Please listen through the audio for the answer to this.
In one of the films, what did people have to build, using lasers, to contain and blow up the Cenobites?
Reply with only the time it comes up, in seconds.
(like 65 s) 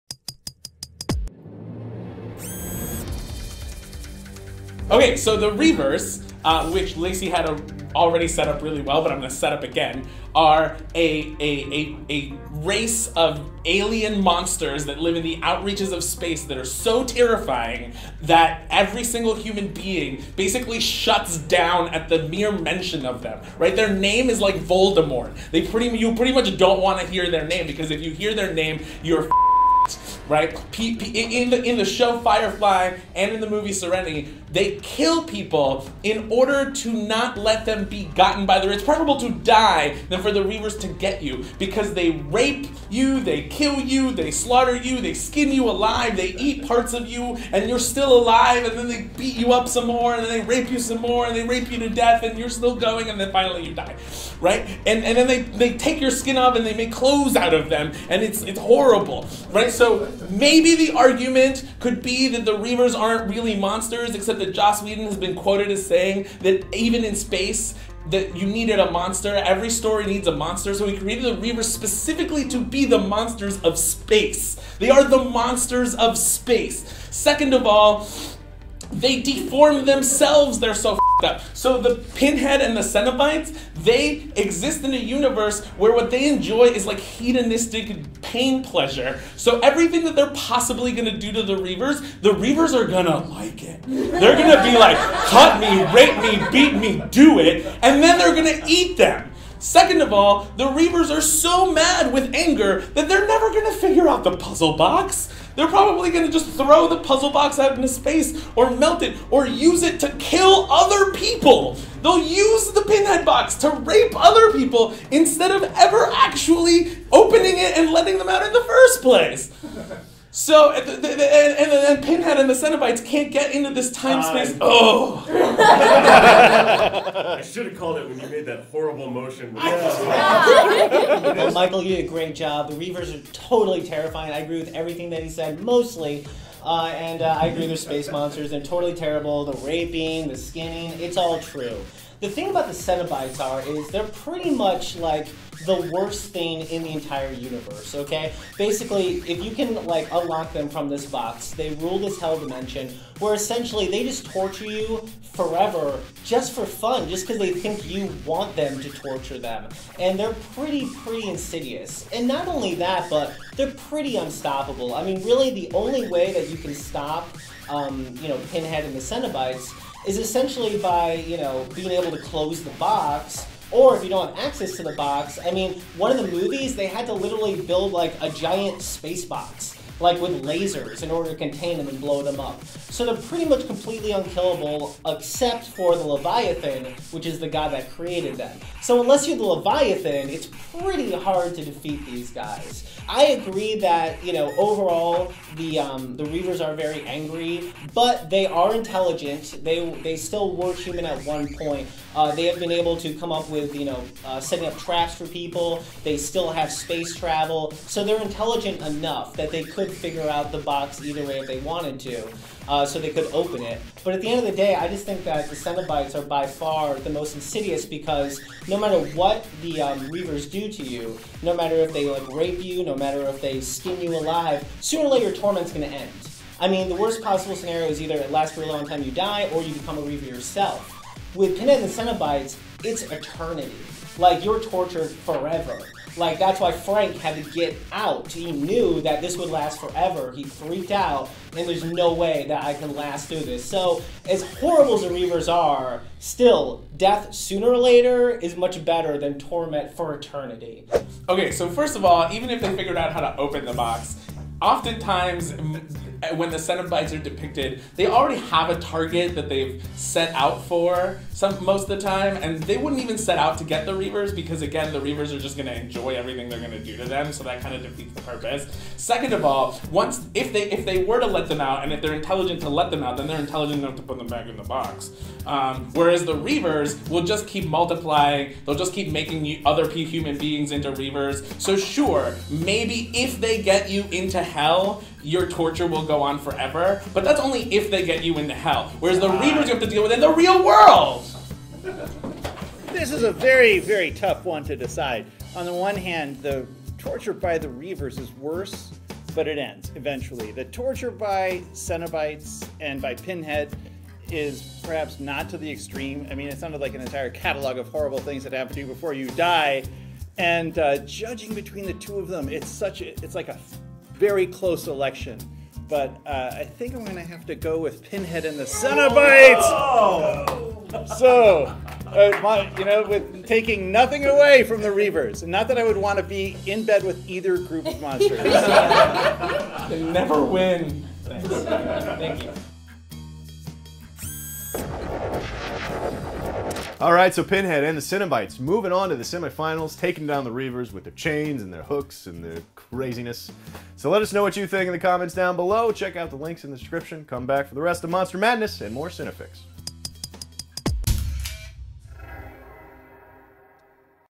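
178 s.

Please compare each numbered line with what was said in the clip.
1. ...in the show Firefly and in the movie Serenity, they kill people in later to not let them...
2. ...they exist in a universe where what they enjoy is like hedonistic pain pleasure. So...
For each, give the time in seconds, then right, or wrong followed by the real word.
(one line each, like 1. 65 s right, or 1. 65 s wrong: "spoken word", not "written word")
1. 31 s wrong: "order", not "later"
2. 83 s right.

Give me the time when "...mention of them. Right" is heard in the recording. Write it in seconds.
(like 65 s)
22 s.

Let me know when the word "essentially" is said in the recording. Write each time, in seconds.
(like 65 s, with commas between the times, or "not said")
153 s, 170 s.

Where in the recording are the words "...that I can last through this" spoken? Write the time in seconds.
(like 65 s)
242 s.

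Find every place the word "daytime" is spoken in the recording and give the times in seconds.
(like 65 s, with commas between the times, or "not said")
not said.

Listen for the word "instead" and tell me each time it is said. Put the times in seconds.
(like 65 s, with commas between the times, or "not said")
115 s.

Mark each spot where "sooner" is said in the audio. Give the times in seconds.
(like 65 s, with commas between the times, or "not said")
224 s, 247 s.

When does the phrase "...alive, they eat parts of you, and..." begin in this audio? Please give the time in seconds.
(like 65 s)
45 s.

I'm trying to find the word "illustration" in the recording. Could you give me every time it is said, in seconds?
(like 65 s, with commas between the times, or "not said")
not said.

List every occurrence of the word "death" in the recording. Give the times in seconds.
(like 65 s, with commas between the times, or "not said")
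51 s, 246 s.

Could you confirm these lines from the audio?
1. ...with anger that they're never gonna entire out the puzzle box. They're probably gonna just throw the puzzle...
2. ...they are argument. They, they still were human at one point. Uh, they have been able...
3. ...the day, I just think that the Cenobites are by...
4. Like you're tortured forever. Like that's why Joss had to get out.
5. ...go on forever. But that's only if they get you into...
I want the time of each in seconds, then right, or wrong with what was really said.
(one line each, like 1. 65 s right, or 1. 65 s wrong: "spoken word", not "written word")
1. 102 s wrong: "figure", not "entire"
2. 198 s wrong: "intelligent", not "argument"
3. 214 s right
4. 234 s wrong: "Frank", not "Joss"
5. 286 s right.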